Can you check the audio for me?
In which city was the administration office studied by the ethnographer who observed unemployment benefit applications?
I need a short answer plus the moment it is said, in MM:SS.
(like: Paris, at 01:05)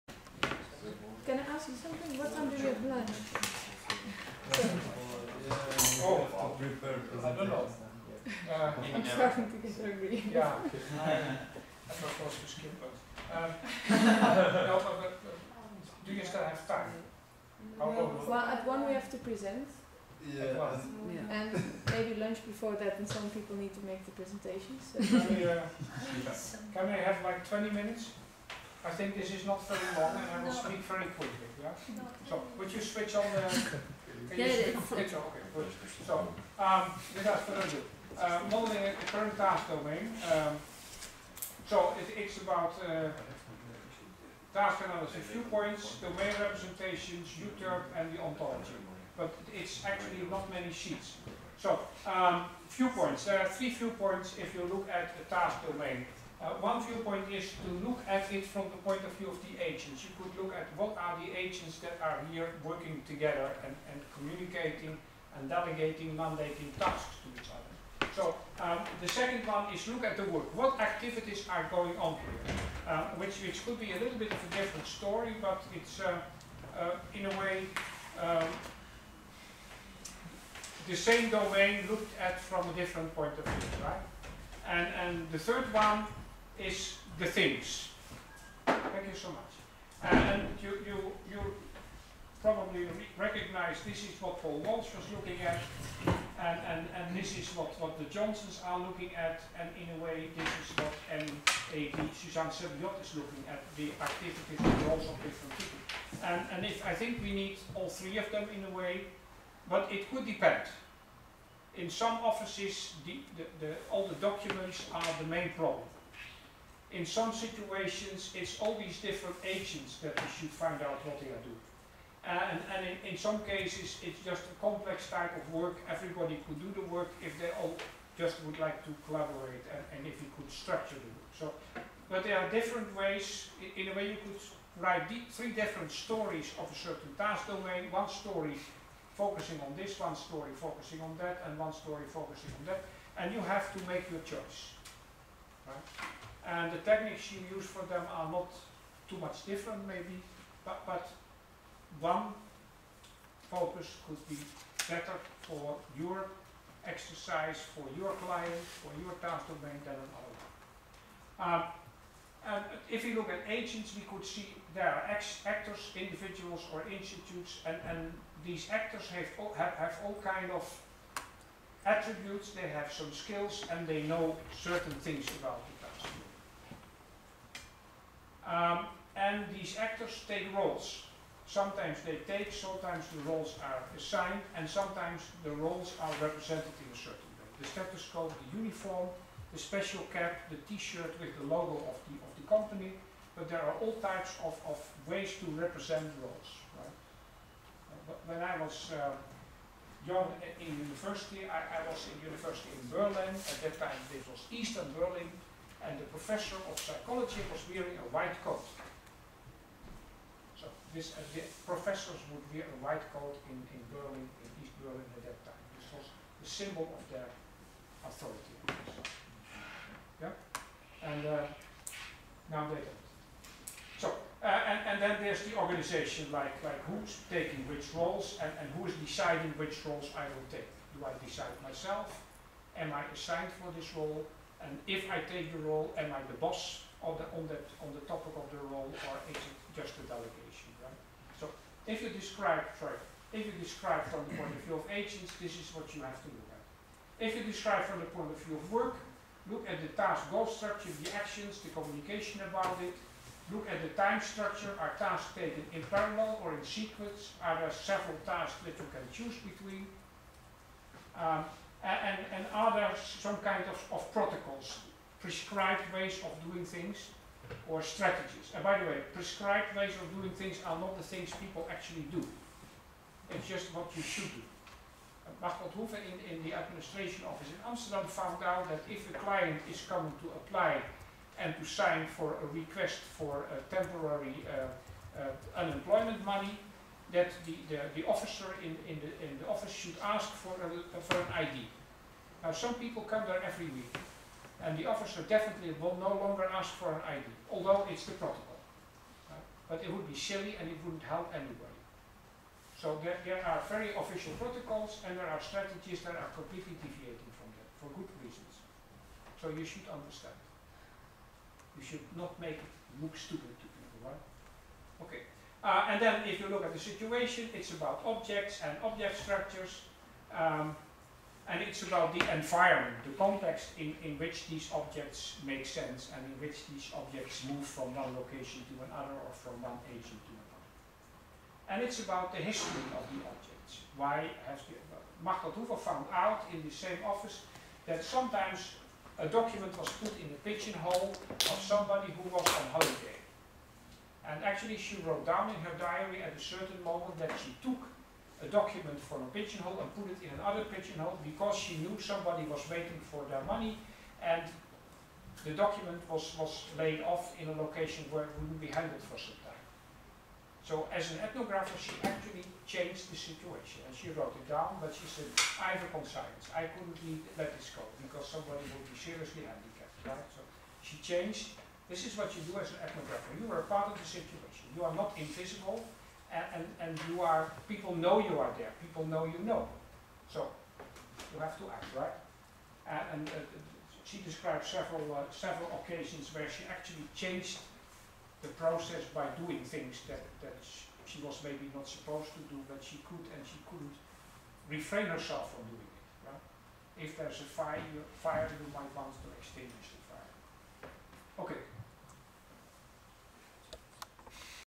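Amsterdam, at 04:37.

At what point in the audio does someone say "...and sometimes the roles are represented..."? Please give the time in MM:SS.
03:04.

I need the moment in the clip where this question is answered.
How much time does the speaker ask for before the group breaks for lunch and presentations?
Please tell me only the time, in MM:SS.
00:27.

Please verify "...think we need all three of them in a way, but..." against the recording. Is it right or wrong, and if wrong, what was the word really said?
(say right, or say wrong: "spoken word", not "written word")
right.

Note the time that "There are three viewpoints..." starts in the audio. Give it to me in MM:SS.
00:53.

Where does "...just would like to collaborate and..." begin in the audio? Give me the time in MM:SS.
02:08.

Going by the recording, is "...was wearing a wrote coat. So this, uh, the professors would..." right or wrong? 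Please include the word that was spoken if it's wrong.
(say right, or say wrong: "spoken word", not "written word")
wrong: "white", not "wrote".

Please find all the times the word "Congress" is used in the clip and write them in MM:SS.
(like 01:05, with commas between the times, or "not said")
not said.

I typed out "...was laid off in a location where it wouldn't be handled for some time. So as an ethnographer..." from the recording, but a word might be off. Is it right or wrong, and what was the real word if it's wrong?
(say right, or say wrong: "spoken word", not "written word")
right.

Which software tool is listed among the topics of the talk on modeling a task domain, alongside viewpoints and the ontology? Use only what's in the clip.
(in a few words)
EUTERPE.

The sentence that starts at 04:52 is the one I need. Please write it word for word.
Now some people come there every week and the officer definitely will no longer ask for an ID, although it's the protocol.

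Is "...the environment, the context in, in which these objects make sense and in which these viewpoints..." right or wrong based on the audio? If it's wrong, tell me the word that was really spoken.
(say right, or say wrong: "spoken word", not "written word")
wrong: "objects", not "viewpoints".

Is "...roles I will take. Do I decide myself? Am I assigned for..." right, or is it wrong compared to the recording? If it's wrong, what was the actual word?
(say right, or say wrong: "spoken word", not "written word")
right.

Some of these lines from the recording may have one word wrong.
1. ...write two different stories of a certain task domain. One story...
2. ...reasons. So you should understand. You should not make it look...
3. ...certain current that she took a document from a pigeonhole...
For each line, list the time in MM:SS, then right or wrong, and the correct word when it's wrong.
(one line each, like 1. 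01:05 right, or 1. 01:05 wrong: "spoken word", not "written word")
1. 02:14 wrong: "three", not "two"
2. 05:08 right
3. 05:46 wrong: "moment", not "current".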